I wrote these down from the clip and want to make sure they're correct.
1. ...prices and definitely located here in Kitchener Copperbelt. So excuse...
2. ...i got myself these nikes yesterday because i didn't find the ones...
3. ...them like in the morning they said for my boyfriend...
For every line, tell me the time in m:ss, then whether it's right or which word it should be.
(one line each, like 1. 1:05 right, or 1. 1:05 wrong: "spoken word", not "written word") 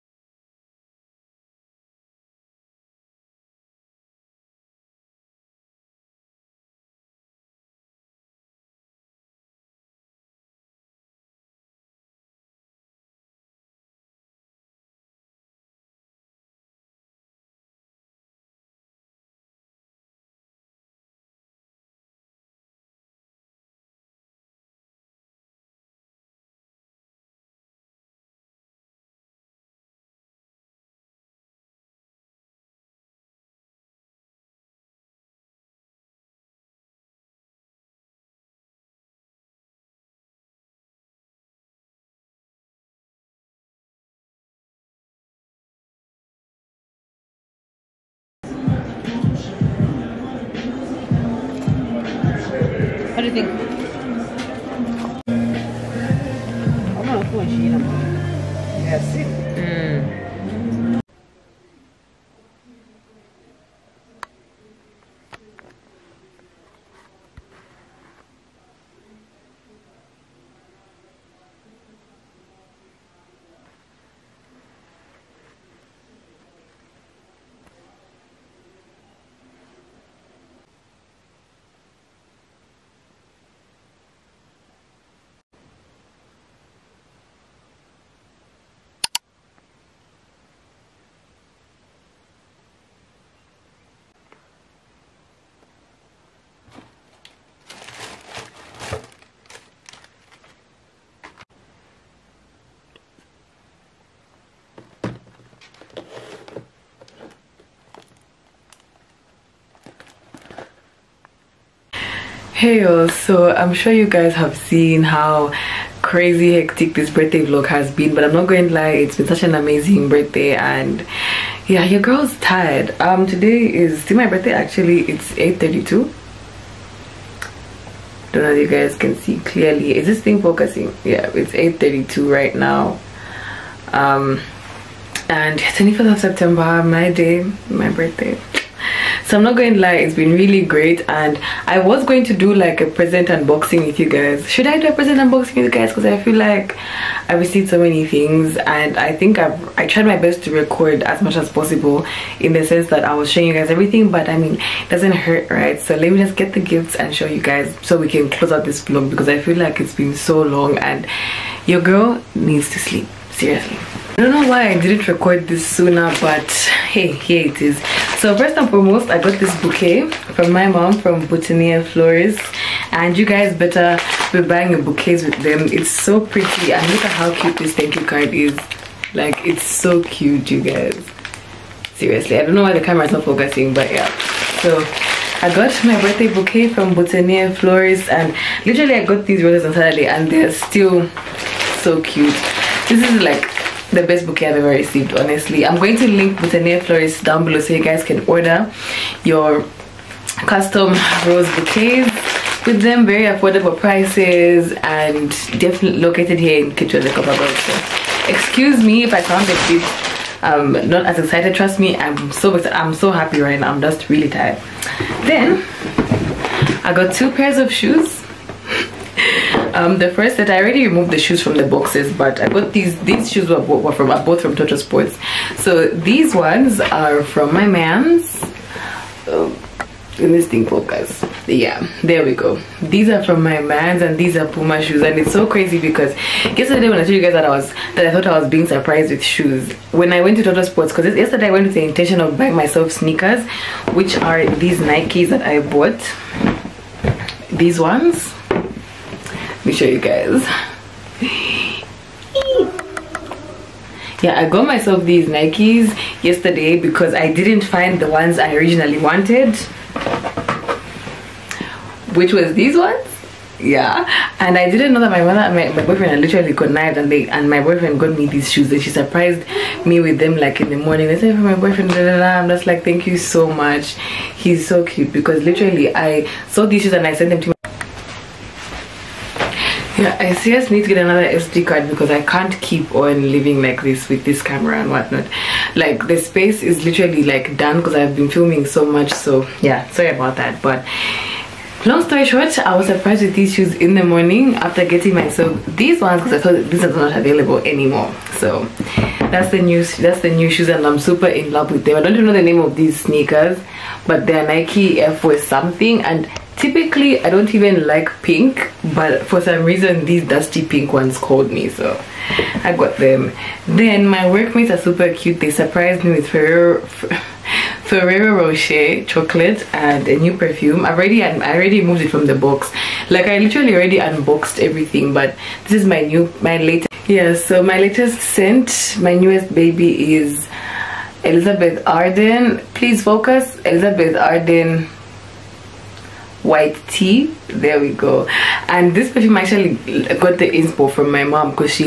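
1. 3:23 right
2. 4:14 right
3. 4:30 right.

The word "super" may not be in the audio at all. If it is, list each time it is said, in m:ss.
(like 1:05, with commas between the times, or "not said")
5:00, 5:14.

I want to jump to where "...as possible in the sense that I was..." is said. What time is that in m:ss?
2:31.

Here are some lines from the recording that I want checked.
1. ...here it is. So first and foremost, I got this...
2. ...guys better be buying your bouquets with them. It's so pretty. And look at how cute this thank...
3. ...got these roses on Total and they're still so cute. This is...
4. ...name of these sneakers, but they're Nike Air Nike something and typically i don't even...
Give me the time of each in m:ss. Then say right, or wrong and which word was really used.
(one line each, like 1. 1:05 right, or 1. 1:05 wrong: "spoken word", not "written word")
1. 2:47 right
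2. 2:53 right
3. 3:09 wrong: "Saturday", not "Total"
4. 5:02 wrong: "Force", not "Nike".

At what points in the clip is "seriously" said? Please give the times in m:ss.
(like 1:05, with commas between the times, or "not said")
2:43, 3:01, 4:40.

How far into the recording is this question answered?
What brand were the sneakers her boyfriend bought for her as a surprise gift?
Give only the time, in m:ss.
3:54.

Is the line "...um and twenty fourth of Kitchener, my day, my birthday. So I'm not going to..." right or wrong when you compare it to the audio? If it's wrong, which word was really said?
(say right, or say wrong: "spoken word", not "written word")
wrong: "September", not "Kitchener".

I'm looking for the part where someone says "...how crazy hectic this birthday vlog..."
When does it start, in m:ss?
1:55.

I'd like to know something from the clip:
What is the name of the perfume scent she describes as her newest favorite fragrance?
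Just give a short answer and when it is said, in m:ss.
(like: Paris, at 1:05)
Elizabeth Arden White Tea, at 5:33.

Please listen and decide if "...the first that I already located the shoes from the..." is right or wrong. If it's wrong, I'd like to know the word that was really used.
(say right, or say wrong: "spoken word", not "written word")
wrong: "removed", not "located".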